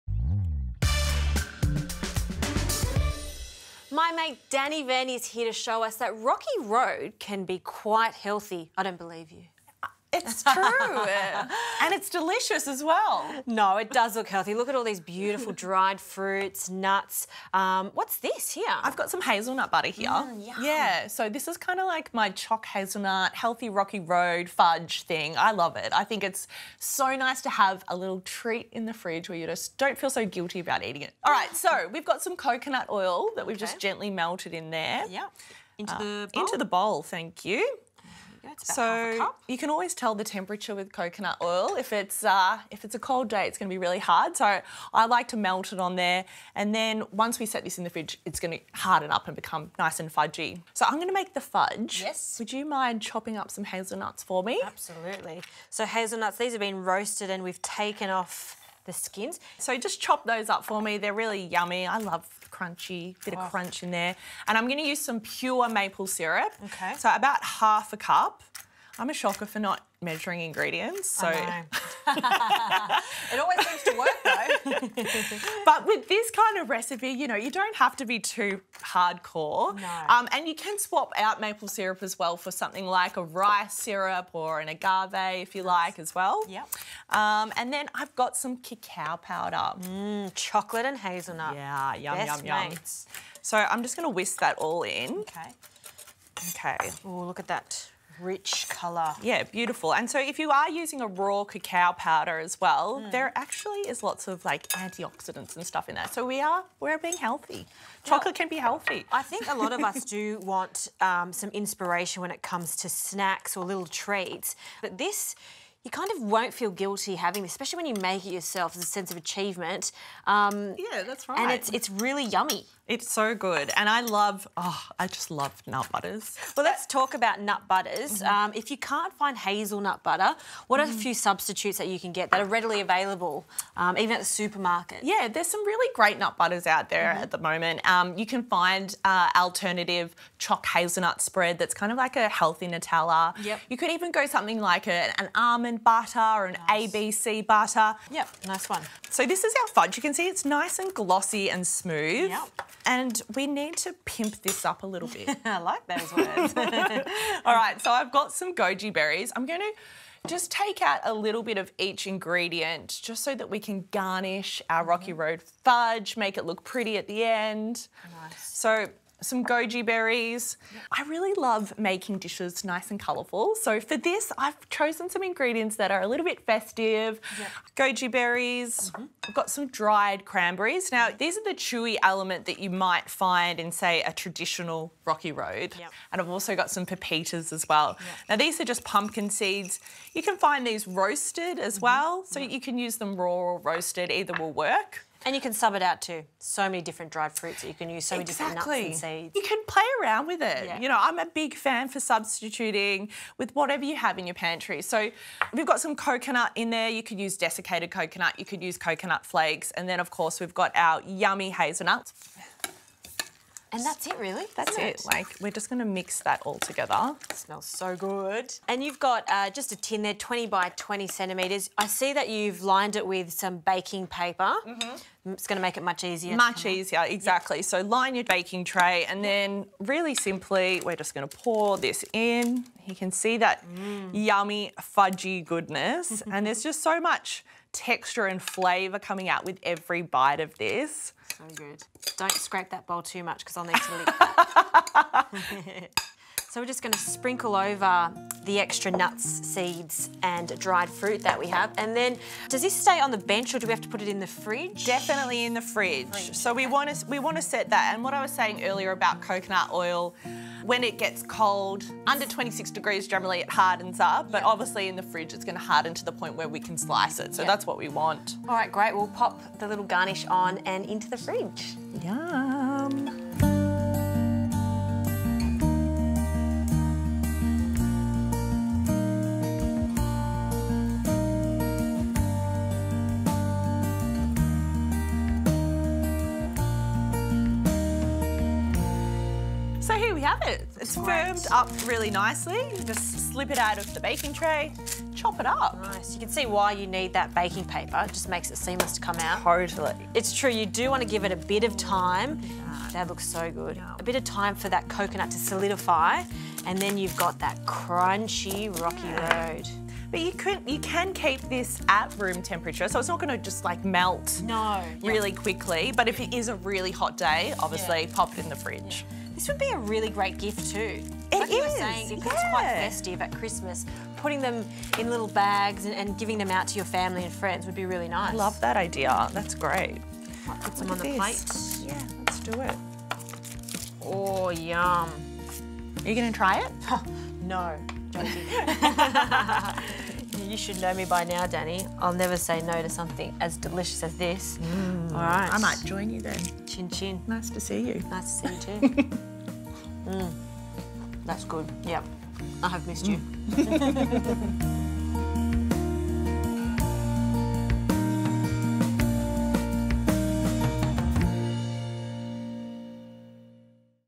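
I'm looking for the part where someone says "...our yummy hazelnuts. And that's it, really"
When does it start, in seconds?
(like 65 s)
210 s.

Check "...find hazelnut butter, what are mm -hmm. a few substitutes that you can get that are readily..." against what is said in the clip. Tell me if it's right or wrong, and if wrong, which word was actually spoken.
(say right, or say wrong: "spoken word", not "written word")
right.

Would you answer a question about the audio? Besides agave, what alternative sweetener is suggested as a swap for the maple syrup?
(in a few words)
Rice syrup.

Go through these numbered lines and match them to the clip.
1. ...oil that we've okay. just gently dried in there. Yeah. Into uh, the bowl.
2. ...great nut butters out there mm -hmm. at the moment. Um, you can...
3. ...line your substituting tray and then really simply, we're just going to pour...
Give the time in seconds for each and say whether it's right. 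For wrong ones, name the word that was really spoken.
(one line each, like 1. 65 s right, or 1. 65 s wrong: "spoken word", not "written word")
1. 32 s wrong: "melted", not "dried"
2. 135 s right
3. 227 s wrong: "baking", not "substituting".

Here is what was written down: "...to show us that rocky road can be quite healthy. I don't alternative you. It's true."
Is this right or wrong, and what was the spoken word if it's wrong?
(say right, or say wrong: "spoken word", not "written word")
wrong: "believe", not "alternative".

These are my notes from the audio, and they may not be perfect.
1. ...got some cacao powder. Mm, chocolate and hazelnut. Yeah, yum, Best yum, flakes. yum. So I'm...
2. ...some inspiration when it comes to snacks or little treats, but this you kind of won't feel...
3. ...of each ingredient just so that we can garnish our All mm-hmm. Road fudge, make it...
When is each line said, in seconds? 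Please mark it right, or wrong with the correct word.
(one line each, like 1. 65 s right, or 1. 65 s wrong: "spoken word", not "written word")
1. 88 s wrong: "mates", not "flakes"
2. 111 s right
3. 161 s wrong: "Rocky", not "All".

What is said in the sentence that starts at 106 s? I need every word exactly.
So we are we're being healthy.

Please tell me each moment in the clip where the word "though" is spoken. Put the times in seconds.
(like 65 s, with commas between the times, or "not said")
74 s.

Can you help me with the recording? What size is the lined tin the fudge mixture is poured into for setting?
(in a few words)
20 by 20 centimetres.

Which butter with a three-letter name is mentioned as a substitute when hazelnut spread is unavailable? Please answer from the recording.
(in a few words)
ABC butter.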